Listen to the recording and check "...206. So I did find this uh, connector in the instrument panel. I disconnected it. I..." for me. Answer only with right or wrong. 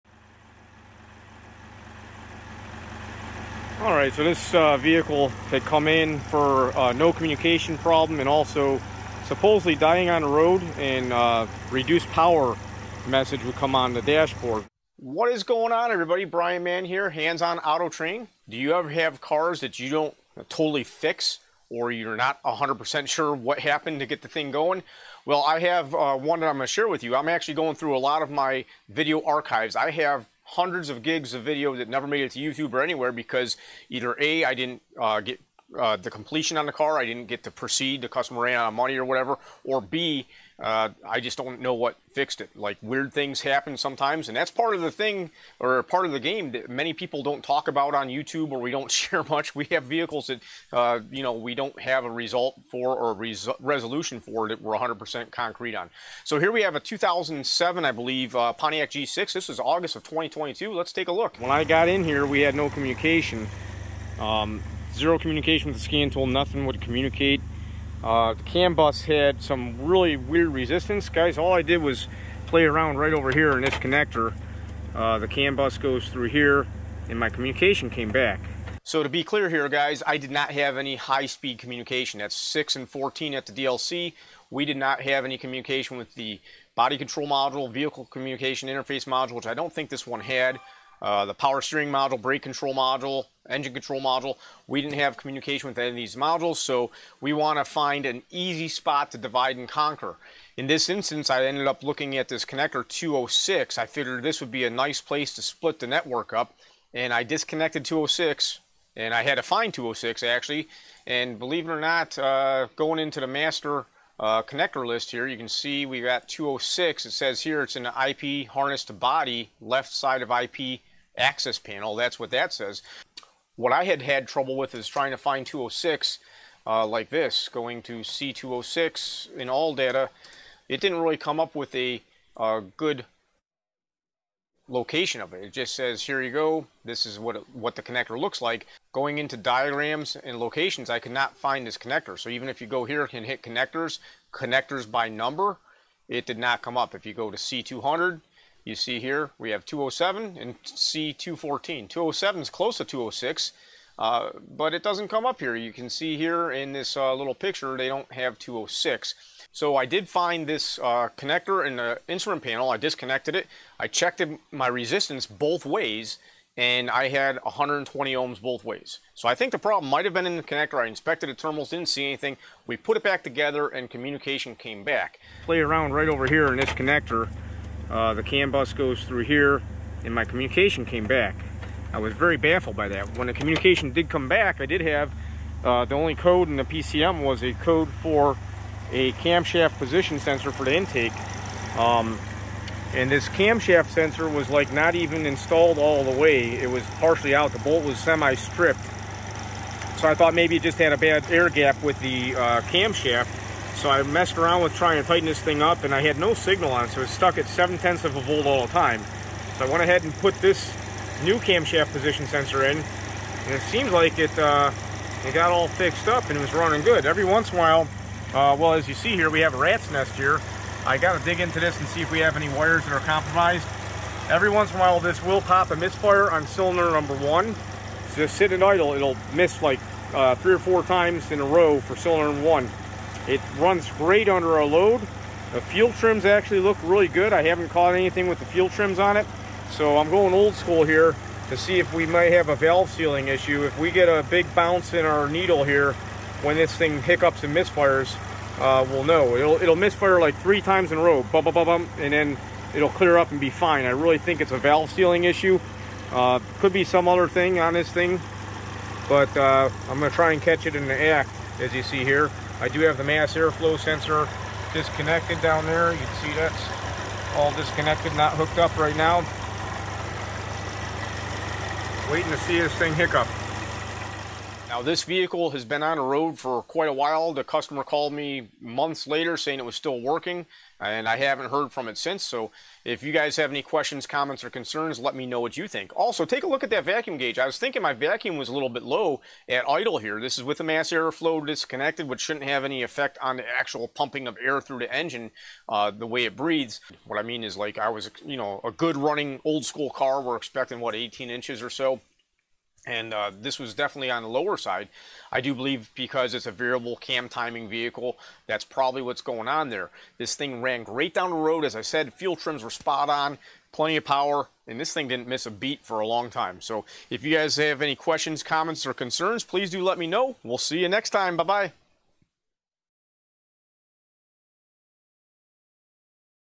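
right.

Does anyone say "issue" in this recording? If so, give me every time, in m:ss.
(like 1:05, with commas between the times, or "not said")
4:03, 4:15.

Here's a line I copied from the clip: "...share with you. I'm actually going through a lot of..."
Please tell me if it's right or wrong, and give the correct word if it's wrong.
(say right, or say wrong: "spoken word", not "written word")
right.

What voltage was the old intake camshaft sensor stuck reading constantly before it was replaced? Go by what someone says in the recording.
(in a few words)
0.7 volts.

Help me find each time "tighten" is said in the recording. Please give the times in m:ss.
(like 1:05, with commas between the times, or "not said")
3:25.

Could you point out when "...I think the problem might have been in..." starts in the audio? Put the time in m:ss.
2:49.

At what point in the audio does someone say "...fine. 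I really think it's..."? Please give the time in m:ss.
4:13.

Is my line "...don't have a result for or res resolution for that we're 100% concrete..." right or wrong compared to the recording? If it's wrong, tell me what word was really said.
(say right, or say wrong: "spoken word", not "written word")
right.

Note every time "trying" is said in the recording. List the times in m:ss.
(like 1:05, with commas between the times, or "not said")
2:04, 3:24.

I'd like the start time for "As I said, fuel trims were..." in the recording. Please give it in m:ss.
5:11.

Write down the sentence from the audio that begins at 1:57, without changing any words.
It says here it's an IP harness to body, left side of IP access panel.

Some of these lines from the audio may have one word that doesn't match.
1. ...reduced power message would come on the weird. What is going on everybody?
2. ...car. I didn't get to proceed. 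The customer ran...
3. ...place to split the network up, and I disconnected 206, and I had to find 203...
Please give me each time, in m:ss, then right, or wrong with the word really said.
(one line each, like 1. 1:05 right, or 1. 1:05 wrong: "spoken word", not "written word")
1. 0:11 wrong: "dashboard", not "weird"
2. 0:36 right
3. 1:45 wrong: "206", not "203".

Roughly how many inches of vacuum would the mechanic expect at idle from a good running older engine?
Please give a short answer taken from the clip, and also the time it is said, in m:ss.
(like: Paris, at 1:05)
18 inches, at 5:00.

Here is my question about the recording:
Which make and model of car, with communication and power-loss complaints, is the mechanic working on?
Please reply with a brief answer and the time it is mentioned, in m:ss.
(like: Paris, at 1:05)
Pontiac G6, at 0:58.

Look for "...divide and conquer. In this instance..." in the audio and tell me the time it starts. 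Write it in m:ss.
1:39.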